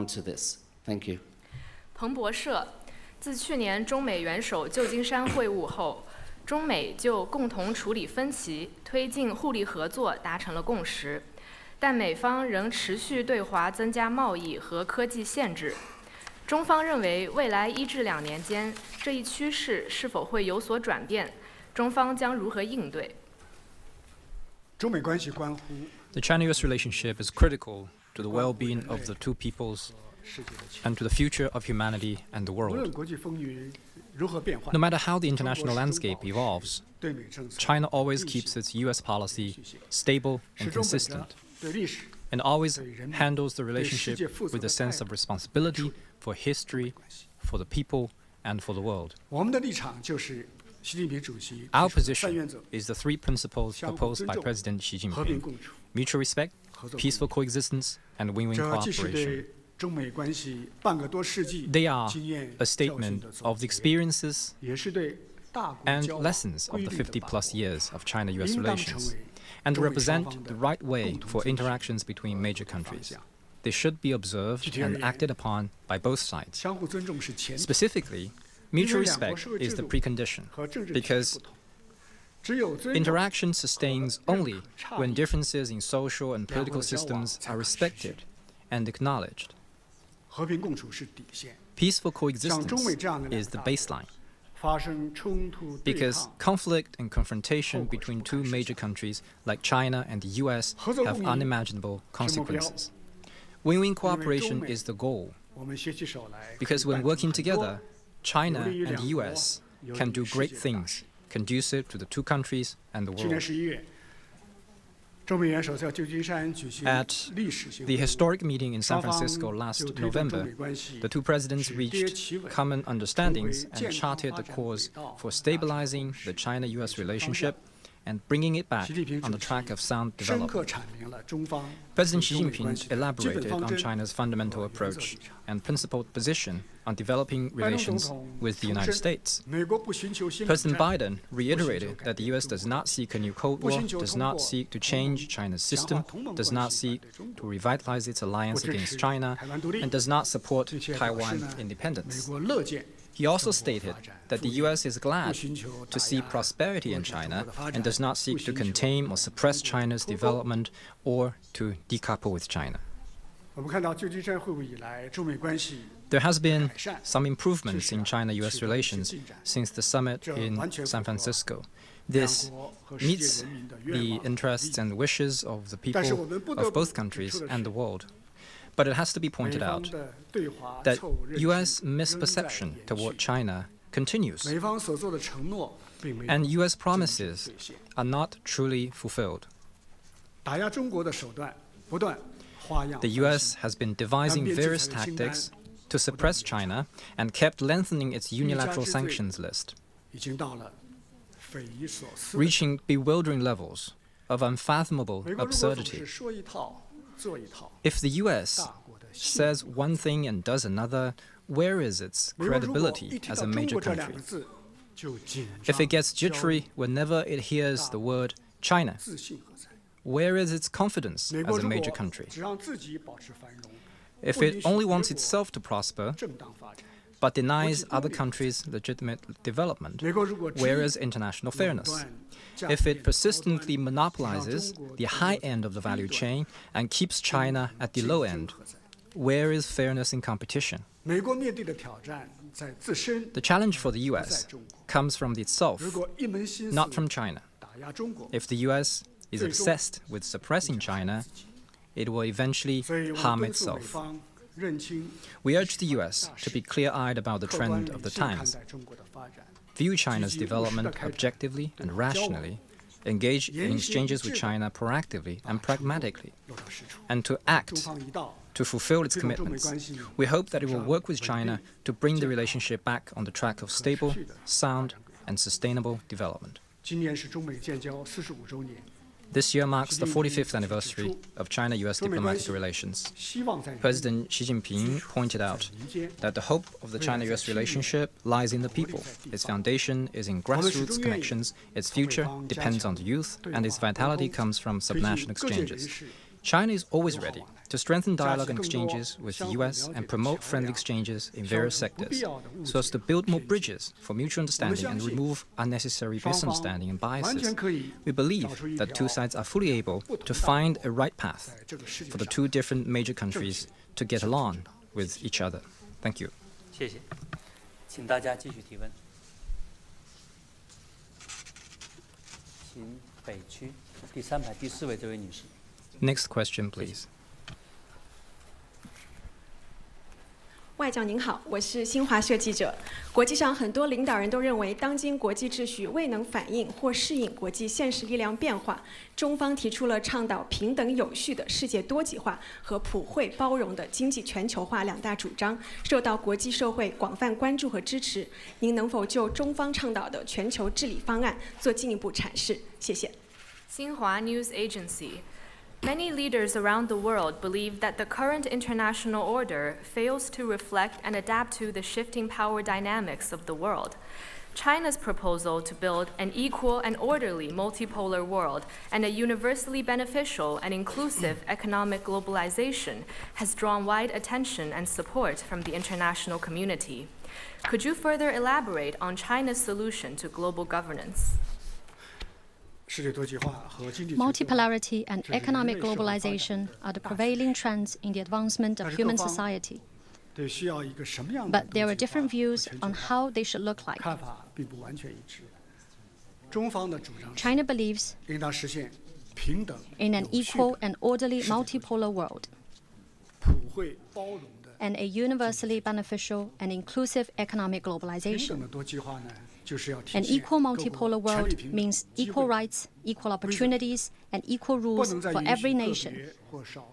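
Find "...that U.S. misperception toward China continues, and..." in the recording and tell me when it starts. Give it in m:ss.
3:00.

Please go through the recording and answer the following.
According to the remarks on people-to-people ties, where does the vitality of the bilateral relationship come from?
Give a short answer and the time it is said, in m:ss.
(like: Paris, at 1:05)
Subnational exchanges, at 4:54.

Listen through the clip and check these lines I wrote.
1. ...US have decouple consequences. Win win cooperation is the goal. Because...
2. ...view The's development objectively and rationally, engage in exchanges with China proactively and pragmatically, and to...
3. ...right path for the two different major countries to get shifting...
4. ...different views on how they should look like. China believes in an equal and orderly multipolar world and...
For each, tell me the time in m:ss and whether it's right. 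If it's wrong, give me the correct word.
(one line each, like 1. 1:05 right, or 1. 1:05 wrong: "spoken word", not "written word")
1. 1:40 wrong: "unimaginable", not "decouple"
2. 4:19 wrong: "China", not "The"
3. 5:10 wrong: "along", not "shifting"
4. 6:31 right.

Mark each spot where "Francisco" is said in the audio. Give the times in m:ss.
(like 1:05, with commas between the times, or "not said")
1:59, 2:51.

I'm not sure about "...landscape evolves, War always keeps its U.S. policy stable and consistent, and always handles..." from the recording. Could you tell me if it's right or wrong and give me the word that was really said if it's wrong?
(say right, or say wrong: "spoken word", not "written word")
wrong: "China", not "War".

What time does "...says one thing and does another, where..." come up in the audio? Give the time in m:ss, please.
3:29.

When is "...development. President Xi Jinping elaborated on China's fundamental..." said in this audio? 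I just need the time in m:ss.
2:10.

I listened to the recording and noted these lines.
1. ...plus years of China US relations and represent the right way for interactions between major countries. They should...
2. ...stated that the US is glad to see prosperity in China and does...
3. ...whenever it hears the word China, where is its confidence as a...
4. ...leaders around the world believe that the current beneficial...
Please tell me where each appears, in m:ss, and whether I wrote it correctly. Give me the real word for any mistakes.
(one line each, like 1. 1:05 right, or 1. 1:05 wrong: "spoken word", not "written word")
1. 1:07 right
2. 2:33 right
3. 3:36 right
4. 5:56 wrong: "international", not "beneficial".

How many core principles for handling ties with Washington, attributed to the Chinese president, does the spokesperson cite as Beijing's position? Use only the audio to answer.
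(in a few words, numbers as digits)
3.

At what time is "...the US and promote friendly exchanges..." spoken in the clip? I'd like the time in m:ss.
4:59.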